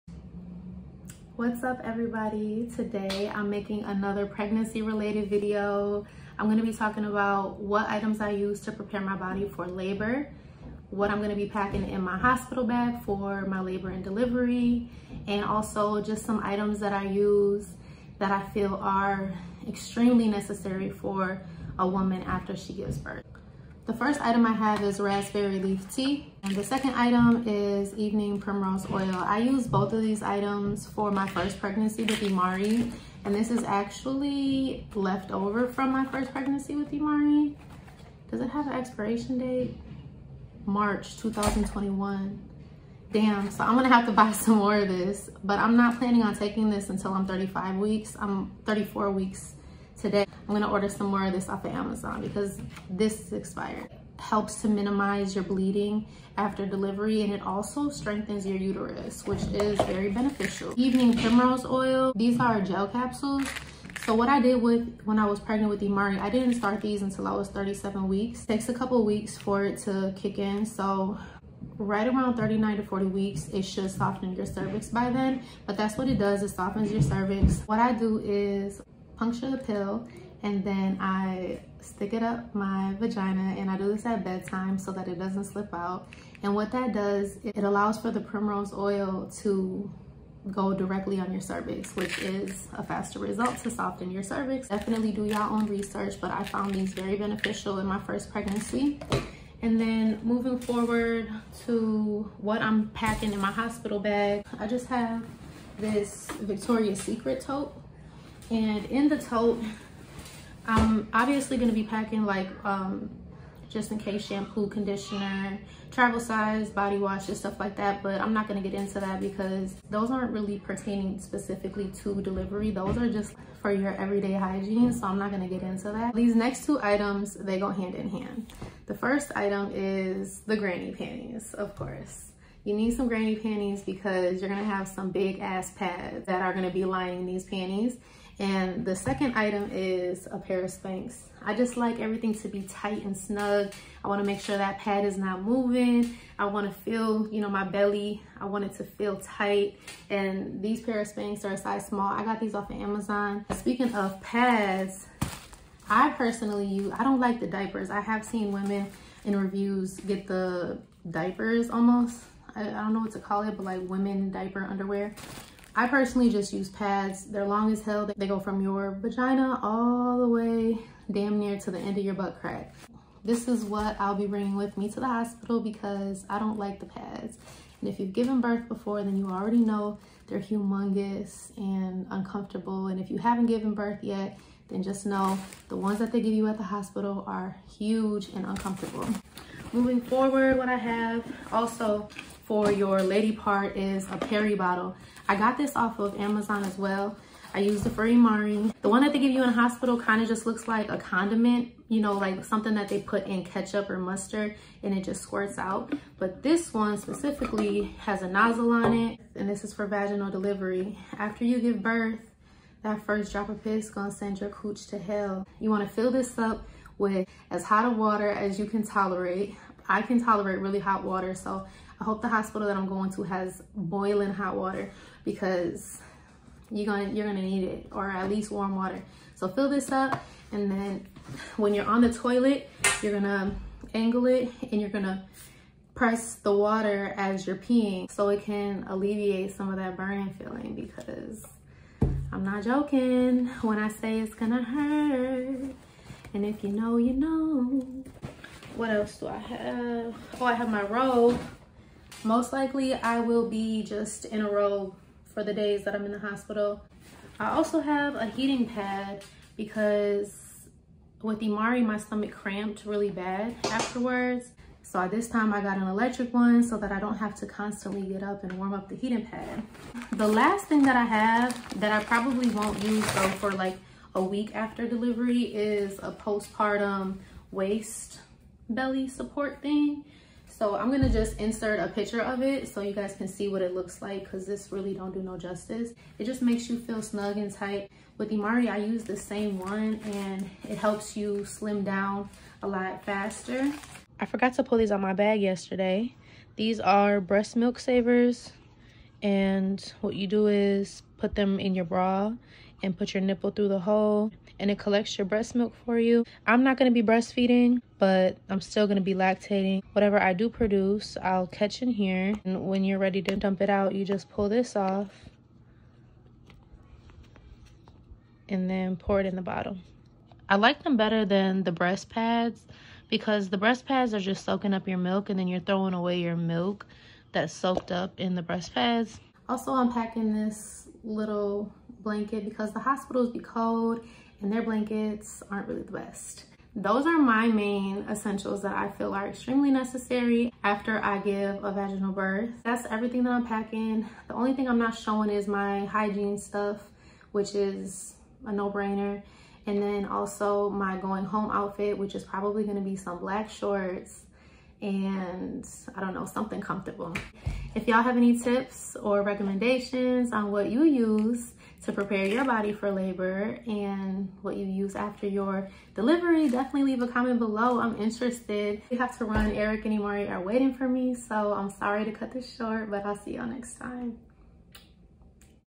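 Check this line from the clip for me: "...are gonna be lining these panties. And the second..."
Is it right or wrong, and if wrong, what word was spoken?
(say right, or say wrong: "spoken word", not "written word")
right.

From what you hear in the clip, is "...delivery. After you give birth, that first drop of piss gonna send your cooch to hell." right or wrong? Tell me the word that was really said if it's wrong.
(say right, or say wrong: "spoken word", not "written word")
right.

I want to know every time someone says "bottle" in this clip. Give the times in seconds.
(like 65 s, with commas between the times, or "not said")
194 s, 319 s.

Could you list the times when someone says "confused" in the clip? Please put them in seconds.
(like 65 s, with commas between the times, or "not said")
not said.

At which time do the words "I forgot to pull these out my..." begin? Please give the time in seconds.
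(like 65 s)
294 s.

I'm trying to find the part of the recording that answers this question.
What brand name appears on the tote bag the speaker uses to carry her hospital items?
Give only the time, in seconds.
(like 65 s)
106 s.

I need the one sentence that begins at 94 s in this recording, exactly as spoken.
Definitely do your own research, but I found these very beneficial in my first pregnancy.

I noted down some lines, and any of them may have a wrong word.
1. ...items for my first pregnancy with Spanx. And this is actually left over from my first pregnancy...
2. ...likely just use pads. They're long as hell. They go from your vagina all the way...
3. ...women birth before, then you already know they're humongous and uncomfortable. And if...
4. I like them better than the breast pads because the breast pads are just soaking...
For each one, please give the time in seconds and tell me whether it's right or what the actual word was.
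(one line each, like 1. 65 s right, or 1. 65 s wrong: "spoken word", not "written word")
1. 30 s wrong: "Imari", not "Spanx"
2. 165 s wrong: "personally", not "likely"
3. 178 s wrong: "given", not "women"
4. 320 s right.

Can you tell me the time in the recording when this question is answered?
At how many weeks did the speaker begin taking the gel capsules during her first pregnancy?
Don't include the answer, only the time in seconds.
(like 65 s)
67 s.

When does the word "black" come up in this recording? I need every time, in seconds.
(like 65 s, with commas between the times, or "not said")
353 s.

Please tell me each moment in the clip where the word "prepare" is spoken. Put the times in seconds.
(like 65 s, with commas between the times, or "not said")
8 s, 361 s.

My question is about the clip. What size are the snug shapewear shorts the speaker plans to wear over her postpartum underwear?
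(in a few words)
Small.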